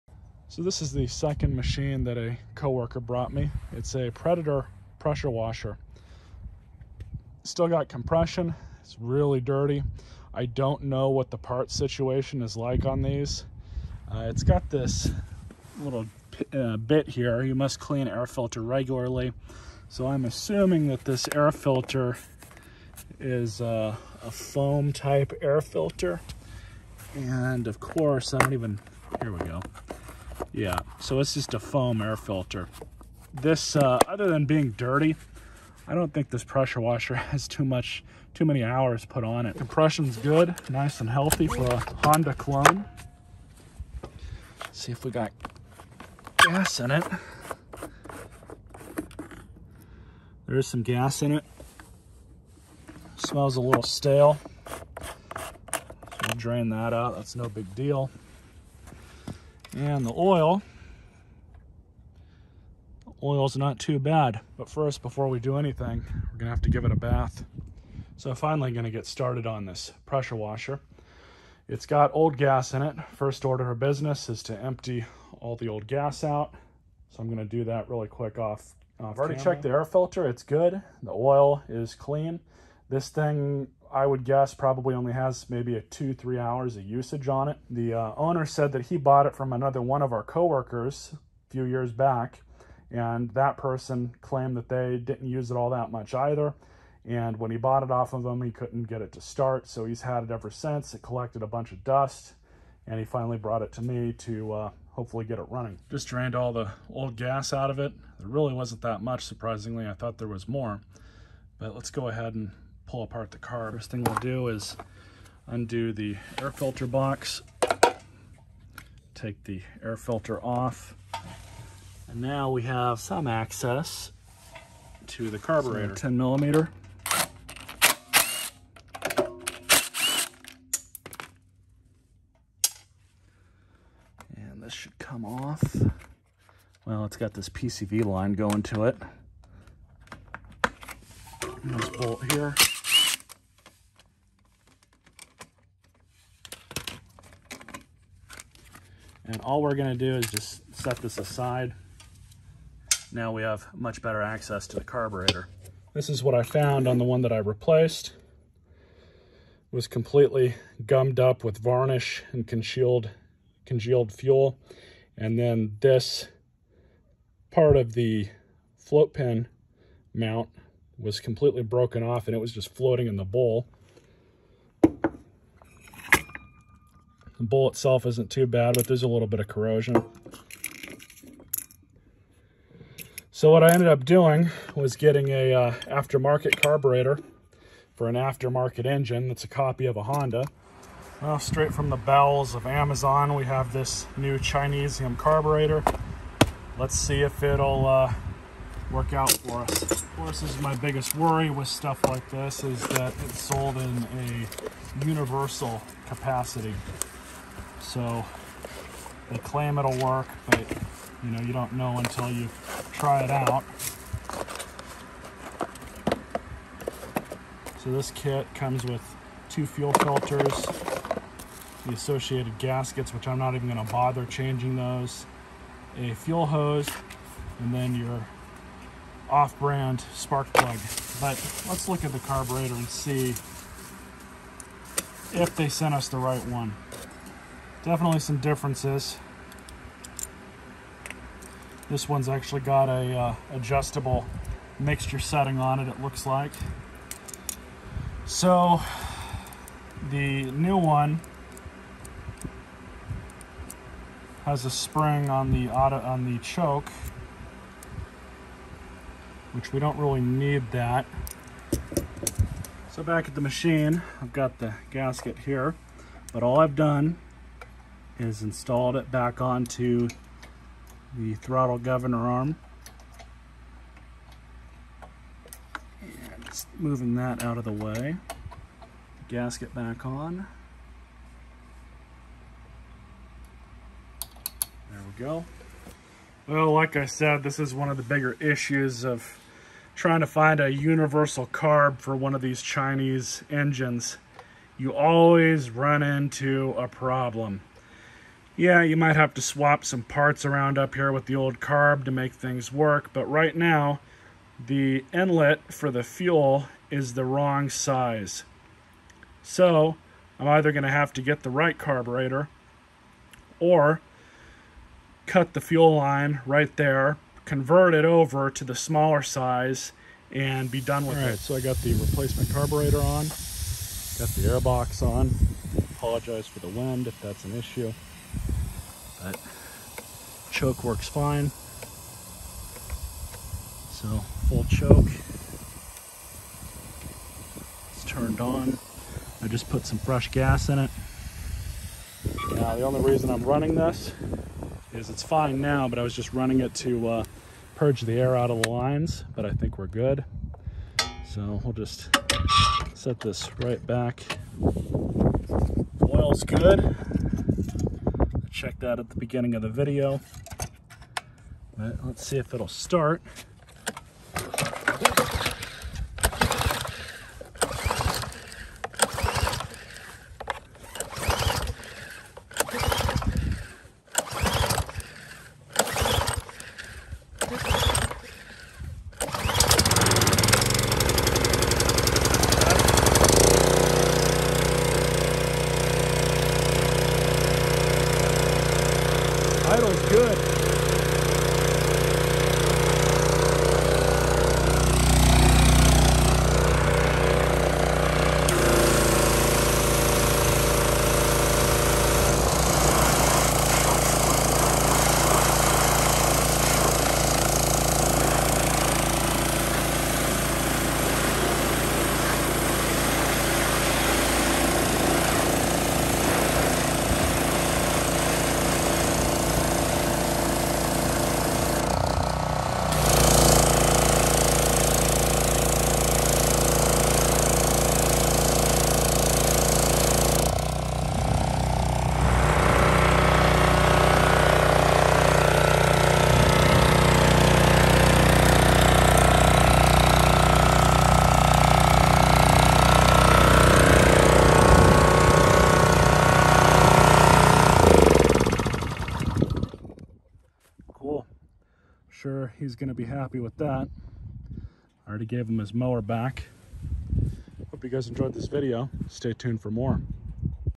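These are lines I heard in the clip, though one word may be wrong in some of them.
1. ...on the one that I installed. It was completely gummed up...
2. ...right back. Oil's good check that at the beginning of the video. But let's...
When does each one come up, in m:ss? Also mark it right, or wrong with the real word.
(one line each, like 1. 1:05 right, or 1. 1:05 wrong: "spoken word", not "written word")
1. 2:36 wrong: "replaced", not "installed"
2. 5:53 right.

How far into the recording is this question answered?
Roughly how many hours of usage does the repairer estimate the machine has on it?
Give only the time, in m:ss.
1:25.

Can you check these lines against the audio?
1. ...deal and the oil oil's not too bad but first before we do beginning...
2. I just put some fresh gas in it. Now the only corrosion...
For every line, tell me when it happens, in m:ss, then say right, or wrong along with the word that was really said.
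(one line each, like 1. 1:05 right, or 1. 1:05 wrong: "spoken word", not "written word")
1. 0:57 wrong: "anything", not "beginning"
2. 5:39 wrong: "reason", not "corrosion".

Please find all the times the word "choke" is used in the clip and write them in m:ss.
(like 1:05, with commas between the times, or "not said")
4:16, 5:30, 5:34.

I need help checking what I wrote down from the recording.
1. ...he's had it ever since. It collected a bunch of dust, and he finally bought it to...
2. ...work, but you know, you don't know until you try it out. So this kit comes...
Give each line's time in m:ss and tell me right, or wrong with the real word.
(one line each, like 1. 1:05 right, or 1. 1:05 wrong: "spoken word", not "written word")
1. 1:39 wrong: "brought", not "bought"
2. 3:30 right.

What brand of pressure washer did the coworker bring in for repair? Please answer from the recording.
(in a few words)
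Predator.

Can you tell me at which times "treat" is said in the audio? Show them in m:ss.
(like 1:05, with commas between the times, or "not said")
not said.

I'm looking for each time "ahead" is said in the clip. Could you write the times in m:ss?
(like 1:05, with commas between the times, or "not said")
1:52.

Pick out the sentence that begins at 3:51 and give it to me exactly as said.
But let's look at the carburetor and see if they sent us the right one.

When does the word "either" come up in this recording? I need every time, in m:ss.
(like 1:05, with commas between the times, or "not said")
1:36, 5:10.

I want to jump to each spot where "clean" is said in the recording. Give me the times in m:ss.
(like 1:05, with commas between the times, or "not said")
0:17, 1:21.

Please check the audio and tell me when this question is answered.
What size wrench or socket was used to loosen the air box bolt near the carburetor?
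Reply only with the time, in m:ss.
2:05.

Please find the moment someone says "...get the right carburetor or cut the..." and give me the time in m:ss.
5:11.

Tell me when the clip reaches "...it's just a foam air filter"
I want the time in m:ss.
0:31.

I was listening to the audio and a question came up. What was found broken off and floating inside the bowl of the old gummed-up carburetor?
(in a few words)
the float pin mount.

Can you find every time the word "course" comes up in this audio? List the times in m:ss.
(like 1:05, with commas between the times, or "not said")
0:27, 3:20.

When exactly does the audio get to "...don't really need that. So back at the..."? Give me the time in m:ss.
4:19.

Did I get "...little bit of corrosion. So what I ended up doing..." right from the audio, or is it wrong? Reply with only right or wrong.
right.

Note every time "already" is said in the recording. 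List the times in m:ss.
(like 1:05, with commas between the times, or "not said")
1:19, 7:35.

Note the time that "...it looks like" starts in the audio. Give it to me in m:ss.
4:05.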